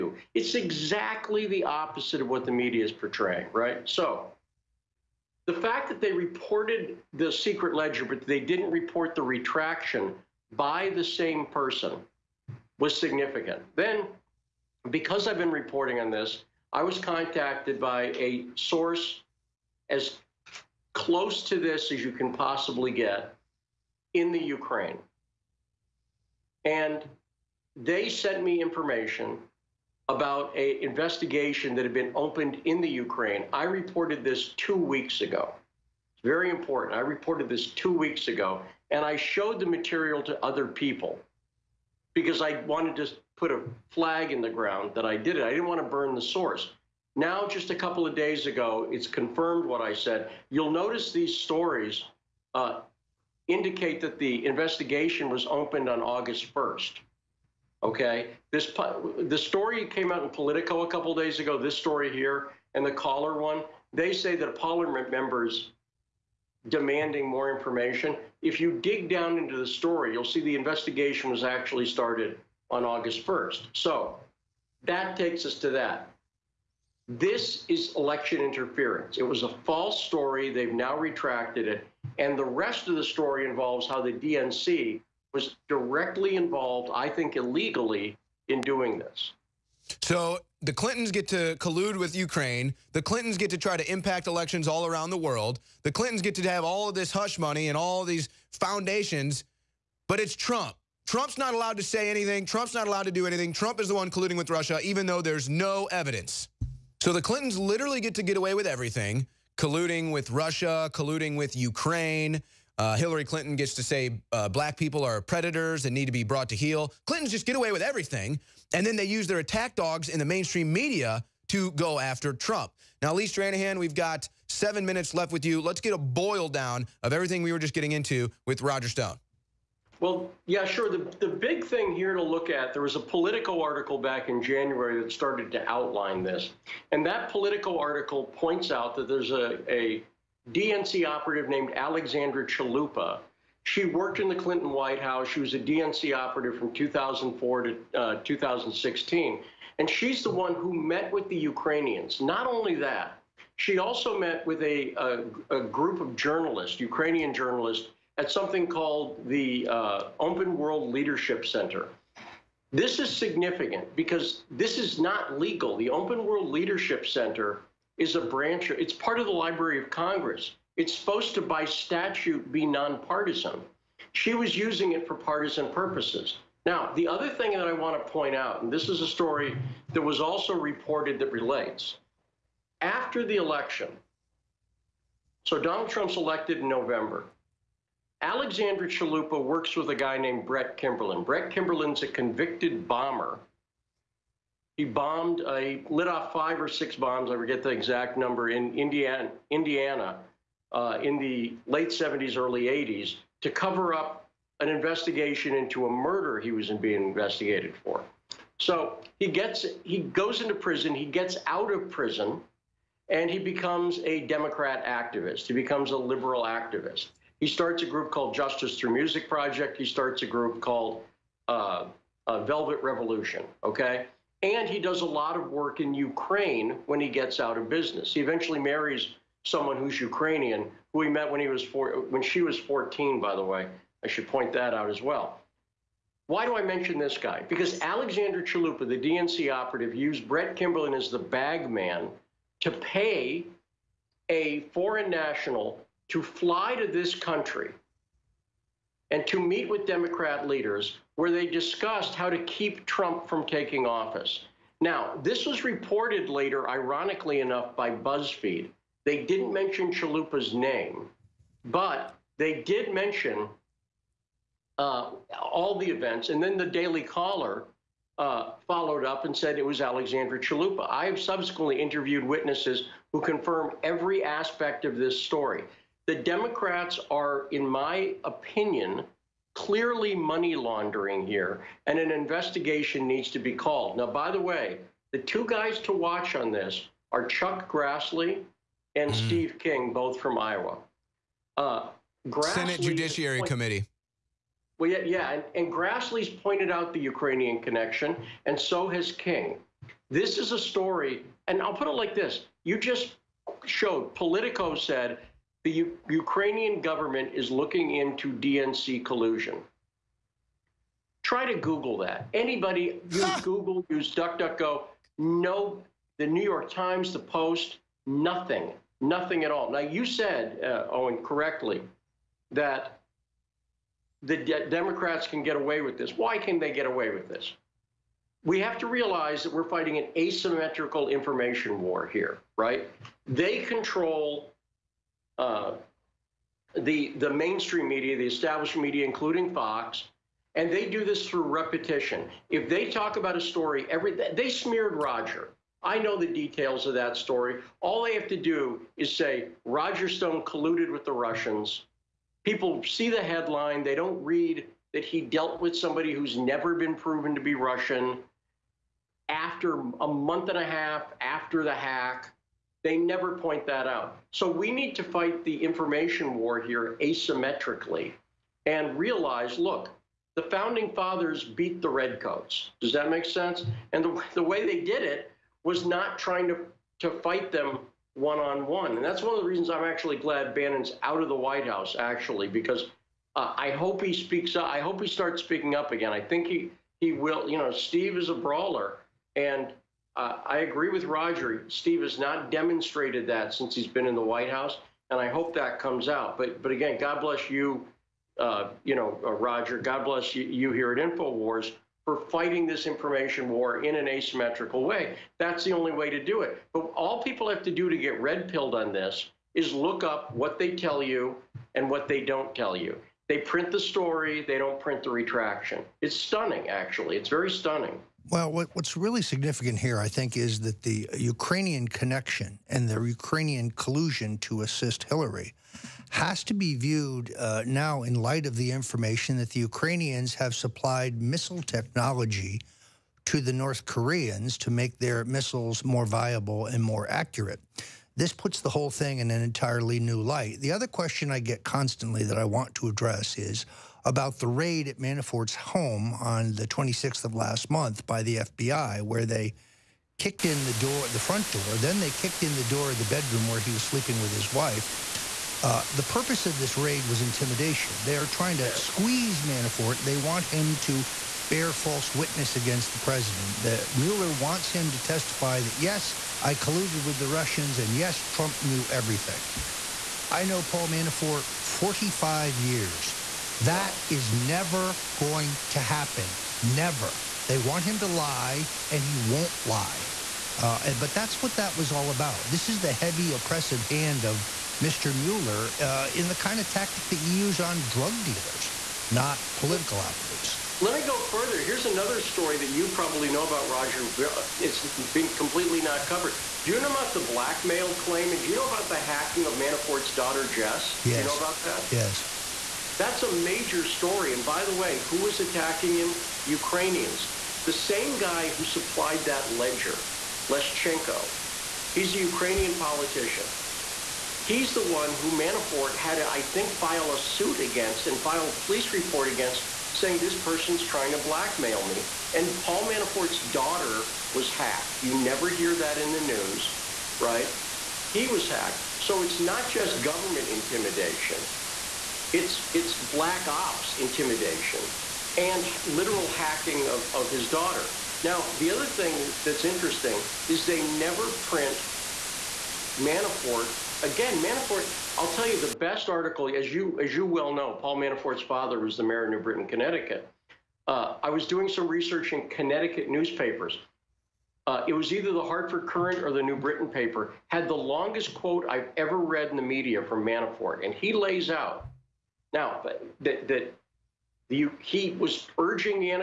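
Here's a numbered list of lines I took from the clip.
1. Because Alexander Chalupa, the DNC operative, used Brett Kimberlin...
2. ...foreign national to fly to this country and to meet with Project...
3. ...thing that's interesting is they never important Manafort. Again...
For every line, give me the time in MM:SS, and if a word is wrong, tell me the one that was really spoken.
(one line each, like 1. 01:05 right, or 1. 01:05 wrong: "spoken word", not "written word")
1. 03:57 right
2. 04:04 wrong: "Democrat", not "Project"
3. 08:58 wrong: "print", not "important".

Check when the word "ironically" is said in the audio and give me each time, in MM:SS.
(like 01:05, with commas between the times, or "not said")
04:16.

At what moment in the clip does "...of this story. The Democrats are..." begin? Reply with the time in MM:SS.
04:34.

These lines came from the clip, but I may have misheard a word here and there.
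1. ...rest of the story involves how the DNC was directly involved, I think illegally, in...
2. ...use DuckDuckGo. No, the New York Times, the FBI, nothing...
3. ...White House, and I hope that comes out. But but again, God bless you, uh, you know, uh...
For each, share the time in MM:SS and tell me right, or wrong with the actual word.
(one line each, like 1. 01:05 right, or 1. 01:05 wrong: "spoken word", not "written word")
1. 01:22 right
2. 05:13 wrong: "Post", not "FBI"
3. 06:34 right.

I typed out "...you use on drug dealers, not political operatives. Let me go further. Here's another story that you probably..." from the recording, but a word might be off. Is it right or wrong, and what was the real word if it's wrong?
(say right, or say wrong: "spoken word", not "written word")
right.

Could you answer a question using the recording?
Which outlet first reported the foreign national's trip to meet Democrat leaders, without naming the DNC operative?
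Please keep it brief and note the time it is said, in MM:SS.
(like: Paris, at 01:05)
BuzzFeed, at 04:17.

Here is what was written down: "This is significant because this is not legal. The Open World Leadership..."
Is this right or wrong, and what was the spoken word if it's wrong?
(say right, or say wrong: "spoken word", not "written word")
right.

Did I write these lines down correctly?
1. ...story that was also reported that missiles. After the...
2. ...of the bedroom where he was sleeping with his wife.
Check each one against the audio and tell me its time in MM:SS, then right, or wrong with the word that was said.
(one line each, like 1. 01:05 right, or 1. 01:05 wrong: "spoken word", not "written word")
1. 02:59 wrong: "relates", not "missiles"
2. 07:32 right.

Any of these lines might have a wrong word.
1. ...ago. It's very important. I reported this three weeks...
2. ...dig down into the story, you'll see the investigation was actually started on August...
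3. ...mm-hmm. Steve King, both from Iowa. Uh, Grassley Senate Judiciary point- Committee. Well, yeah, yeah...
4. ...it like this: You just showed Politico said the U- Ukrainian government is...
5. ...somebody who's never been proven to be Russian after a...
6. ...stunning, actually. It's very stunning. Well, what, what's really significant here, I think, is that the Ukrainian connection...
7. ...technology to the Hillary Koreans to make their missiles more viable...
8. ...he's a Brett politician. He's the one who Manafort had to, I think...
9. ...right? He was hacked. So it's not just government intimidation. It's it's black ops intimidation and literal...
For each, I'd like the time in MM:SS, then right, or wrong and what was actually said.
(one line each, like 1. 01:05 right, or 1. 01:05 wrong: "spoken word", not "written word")
1. 00:35 wrong: "two", not "three"
2. 01:08 right
3. 04:49 right
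4. 05:01 right
5. 05:55 right
6. 06:56 right
7. 07:11 wrong: "North", not "Hillary"
8. 08:31 wrong: "Ukrainian", not "Brett"
9. 08:47 right.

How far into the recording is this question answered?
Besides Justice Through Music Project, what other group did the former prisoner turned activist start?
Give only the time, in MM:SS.
03:42.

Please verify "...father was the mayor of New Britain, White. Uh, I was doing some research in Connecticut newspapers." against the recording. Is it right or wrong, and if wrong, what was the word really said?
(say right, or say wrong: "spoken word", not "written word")
wrong: "Connecticut", not "White".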